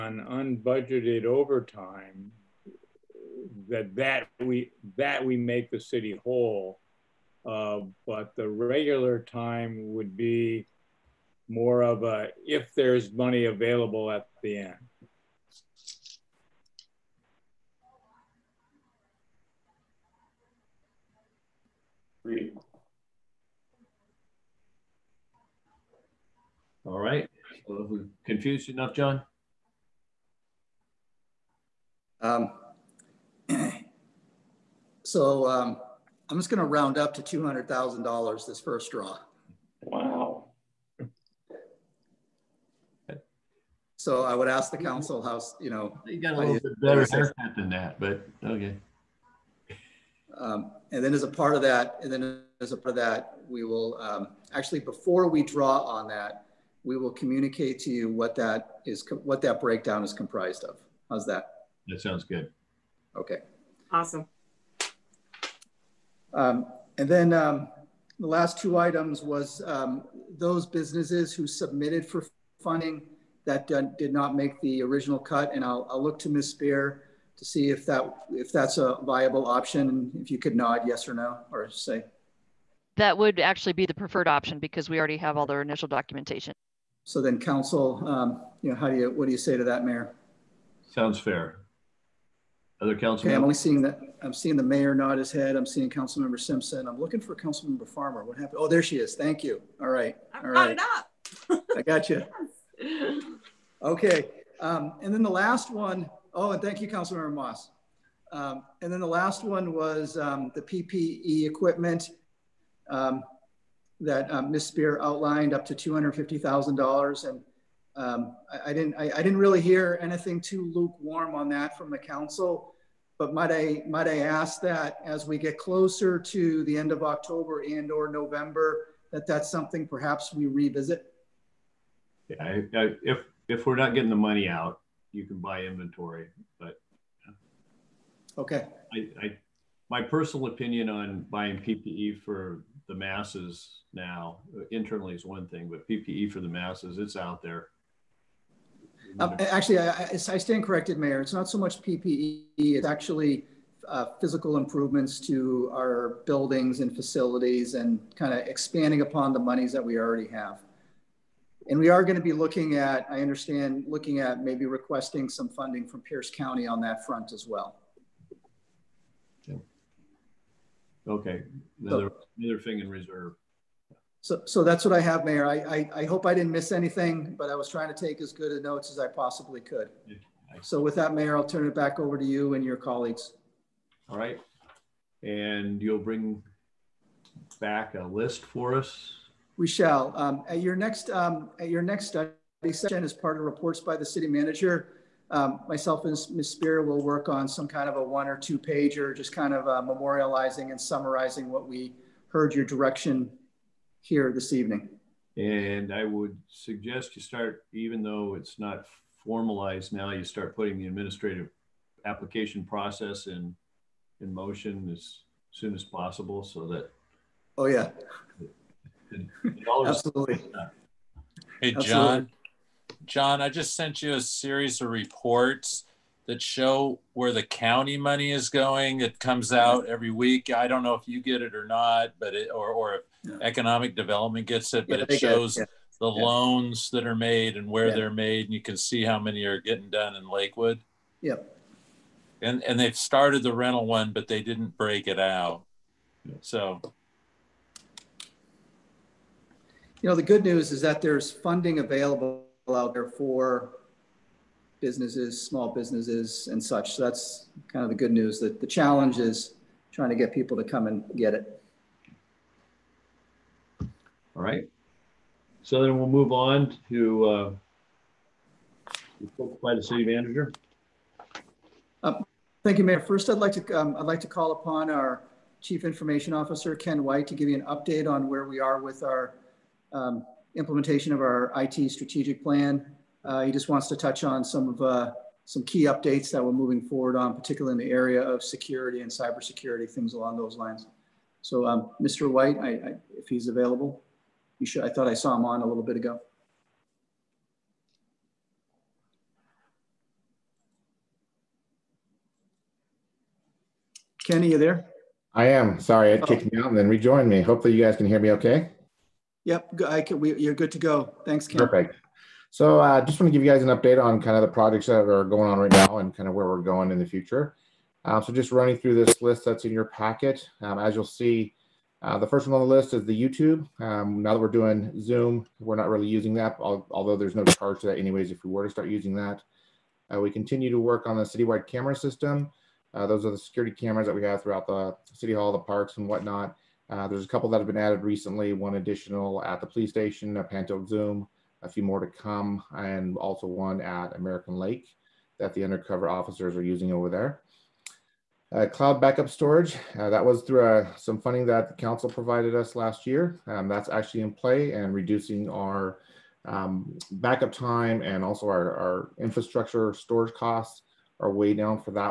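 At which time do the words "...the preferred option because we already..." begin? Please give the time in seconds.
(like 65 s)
83 s.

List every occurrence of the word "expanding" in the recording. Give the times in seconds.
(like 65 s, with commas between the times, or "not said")
158 s.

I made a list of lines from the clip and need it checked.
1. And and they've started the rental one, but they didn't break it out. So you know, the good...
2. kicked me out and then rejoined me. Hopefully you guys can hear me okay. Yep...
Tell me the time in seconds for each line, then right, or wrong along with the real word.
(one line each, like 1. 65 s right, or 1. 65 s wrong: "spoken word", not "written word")
1. 242 s right
2. 306 s right.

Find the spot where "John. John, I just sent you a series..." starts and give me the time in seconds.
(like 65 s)
221 s.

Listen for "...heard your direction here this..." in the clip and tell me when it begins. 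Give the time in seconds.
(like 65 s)
202 s.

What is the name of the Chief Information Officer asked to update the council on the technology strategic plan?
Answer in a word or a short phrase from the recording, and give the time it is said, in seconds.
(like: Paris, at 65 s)
Ken White, at 276 s.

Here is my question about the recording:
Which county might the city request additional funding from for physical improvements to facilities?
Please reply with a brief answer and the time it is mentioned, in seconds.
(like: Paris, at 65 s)
Pierce County, at 166 s.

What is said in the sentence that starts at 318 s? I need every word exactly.
Um, so just running through this list that's in your packet.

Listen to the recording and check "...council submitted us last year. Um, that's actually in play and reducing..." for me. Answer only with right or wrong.
wrong.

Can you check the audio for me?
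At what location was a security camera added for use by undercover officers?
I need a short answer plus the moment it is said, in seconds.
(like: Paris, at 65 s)
American Lake, at 344 s.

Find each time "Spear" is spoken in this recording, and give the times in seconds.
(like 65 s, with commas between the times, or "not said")
76 s, 114 s, 196 s.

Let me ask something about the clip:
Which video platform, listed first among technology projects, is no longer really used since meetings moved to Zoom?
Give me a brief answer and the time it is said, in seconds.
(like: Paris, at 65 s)
YouTube, at 323 s.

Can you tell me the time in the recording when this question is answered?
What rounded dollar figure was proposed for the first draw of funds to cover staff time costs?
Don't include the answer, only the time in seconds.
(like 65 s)
37 s.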